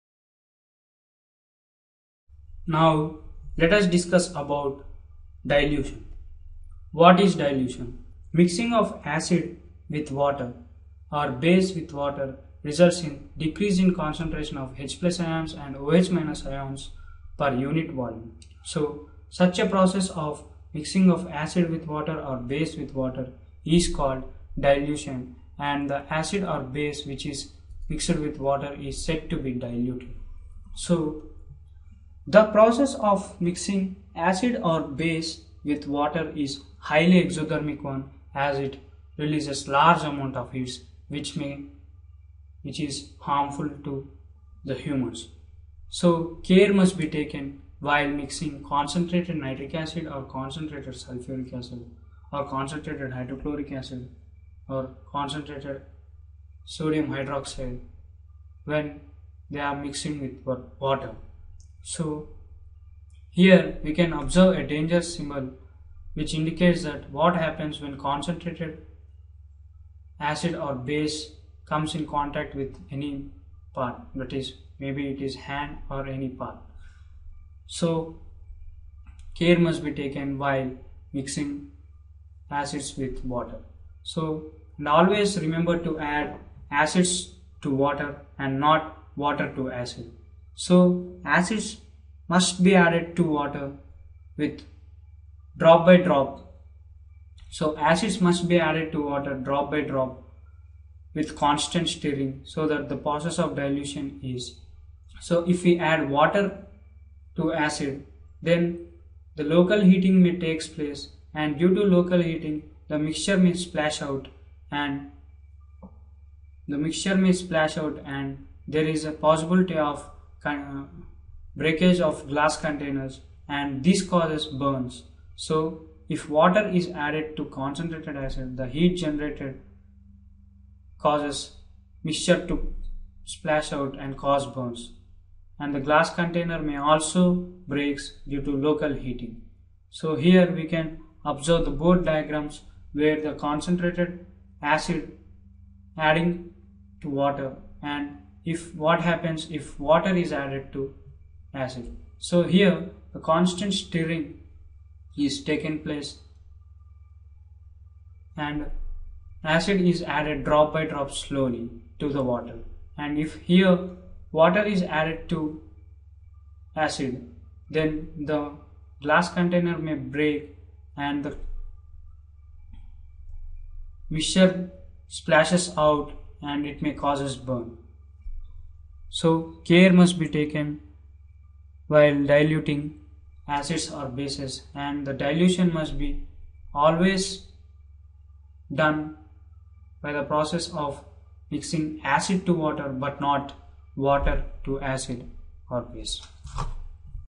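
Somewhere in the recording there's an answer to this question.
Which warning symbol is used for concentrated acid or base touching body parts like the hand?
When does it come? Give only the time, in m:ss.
1:04.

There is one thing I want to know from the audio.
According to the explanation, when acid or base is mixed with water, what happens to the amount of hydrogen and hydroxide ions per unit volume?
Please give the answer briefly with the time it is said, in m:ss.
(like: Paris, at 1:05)
Decrease in concentration, at 0:13.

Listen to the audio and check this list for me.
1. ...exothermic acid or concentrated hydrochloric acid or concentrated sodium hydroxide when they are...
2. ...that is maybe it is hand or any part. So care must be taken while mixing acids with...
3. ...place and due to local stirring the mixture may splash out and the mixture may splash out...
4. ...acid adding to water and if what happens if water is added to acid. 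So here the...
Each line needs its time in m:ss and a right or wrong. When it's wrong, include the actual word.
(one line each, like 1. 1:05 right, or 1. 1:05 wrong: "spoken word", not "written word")
1. 0:51 wrong: "sulfuric", not "exothermic"
2. 1:14 right
3. 1:50 wrong: "heating", not "stirring"
4. 2:24 right.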